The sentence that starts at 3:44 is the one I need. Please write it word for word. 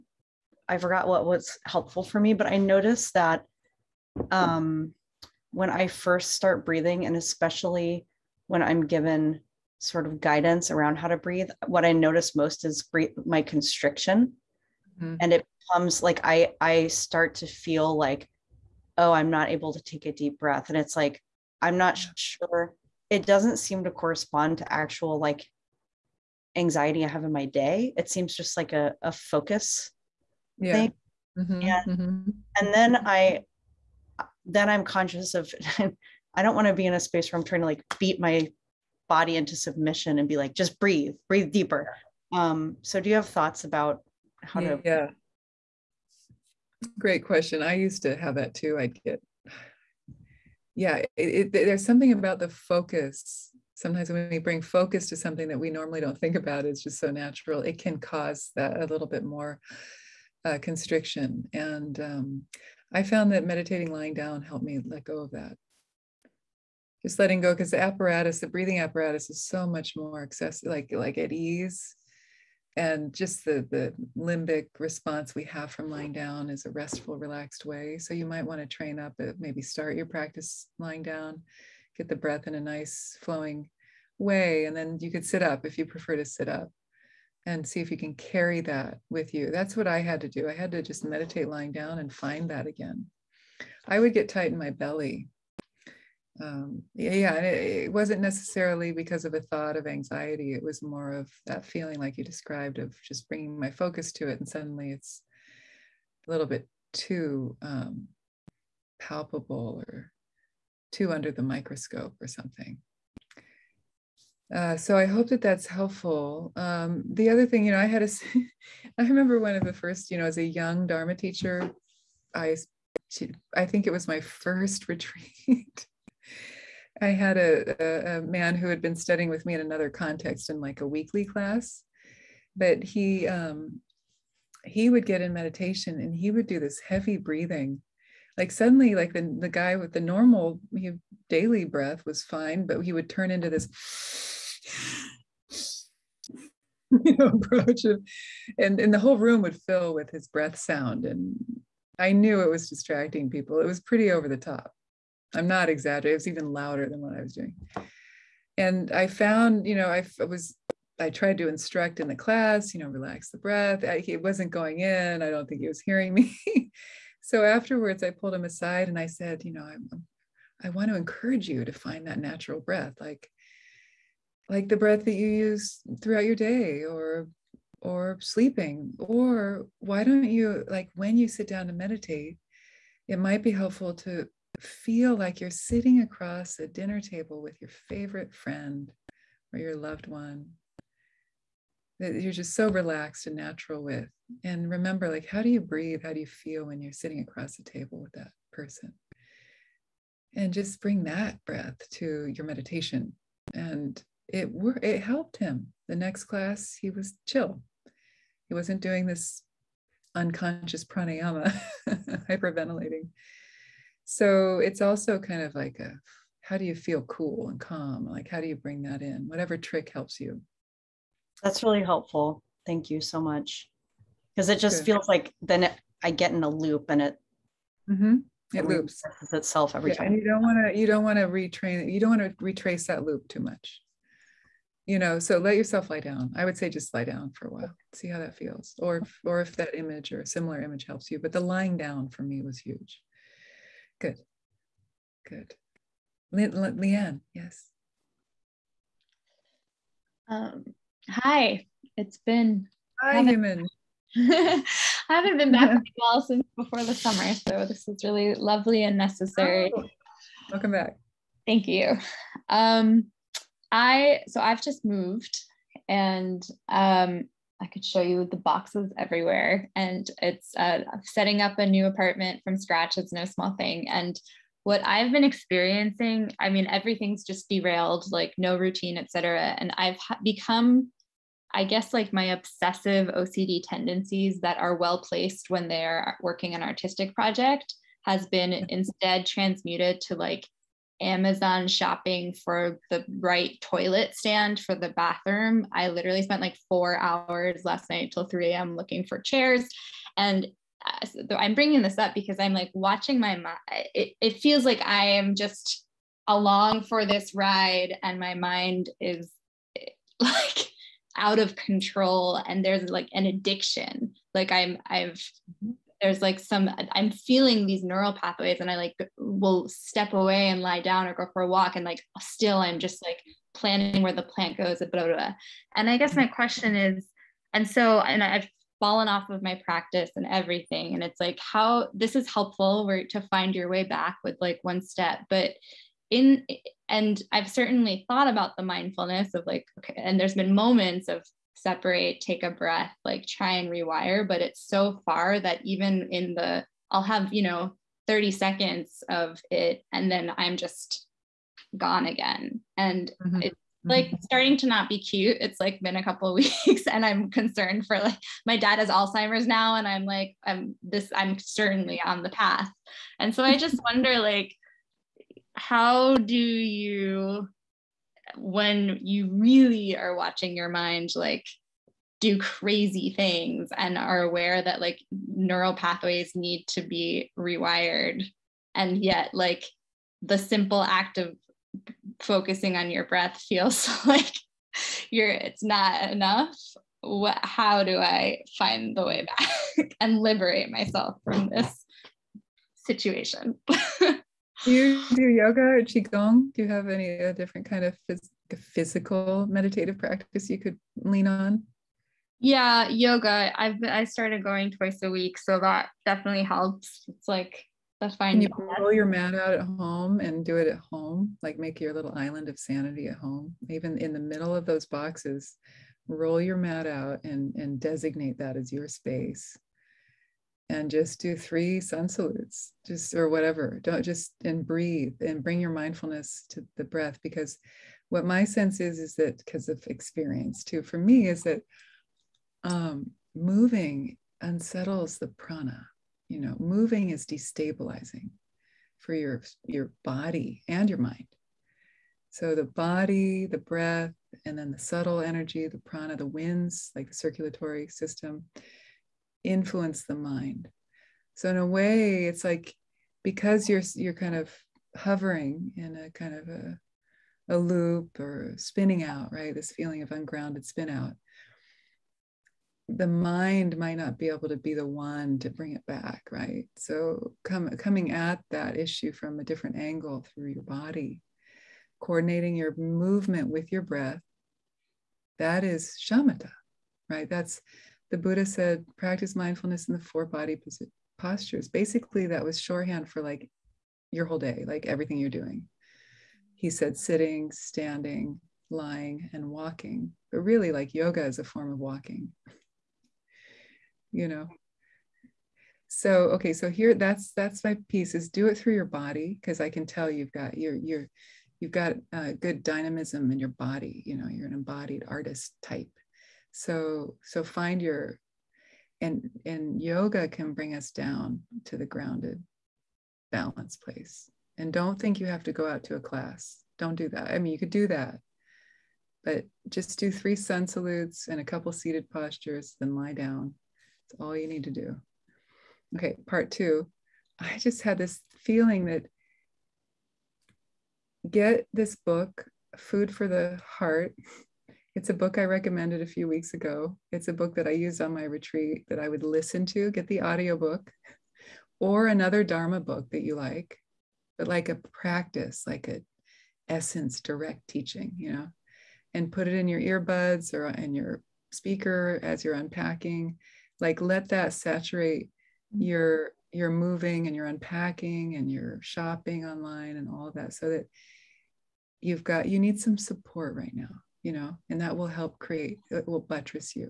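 feels like then it, I get in a loop and it mm-hmm.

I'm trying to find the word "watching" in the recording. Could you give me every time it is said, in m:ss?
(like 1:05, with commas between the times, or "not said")
5:02, 6:10.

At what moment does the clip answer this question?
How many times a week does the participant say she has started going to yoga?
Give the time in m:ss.
6:44.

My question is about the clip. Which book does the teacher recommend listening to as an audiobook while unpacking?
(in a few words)
Food for the Heart.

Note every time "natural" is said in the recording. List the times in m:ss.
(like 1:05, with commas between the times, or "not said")
0:57, 2:52, 3:13.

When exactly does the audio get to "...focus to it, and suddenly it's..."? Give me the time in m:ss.
1:43.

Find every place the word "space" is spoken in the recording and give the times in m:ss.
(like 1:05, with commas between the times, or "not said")
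0:36, 6:58.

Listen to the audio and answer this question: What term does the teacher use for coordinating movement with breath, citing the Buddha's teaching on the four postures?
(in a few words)
Shamatha.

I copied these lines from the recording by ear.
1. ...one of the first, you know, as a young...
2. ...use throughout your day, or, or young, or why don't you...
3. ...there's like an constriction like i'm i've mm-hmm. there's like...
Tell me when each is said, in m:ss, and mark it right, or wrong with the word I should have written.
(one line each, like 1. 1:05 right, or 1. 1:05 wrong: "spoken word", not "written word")
1. 1:59 right
2. 2:55 wrong: "sleeping", not "young"
3. 5:12 wrong: "addiction", not "constriction".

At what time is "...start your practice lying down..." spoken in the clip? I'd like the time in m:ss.
1:19.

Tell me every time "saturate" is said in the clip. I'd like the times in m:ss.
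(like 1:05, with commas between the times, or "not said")
9:14.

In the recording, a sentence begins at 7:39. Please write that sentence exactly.
This feeling of ungrounded spin out.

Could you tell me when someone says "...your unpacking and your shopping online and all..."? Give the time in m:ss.
9:17.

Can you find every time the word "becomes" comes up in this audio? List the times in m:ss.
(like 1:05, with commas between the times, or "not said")
0:15, 4:40.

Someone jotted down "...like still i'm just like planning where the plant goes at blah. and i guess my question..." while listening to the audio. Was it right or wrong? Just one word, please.
right.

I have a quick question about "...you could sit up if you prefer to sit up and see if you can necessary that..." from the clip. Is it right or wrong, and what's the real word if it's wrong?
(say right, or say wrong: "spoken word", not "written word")
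wrong: "carry", not "necessary".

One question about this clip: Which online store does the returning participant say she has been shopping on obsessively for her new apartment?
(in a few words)
Amazon.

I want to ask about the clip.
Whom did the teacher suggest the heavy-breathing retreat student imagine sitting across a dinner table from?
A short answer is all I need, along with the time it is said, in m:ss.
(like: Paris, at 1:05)
Favorite friend, at 3:07.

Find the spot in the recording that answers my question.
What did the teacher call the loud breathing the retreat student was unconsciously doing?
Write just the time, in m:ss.
3:30.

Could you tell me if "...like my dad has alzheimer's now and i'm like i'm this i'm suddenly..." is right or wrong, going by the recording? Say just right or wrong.
wrong.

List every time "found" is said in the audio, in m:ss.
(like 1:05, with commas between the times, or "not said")
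1:03, 2:39.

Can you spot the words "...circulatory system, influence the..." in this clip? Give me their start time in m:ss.
7:27.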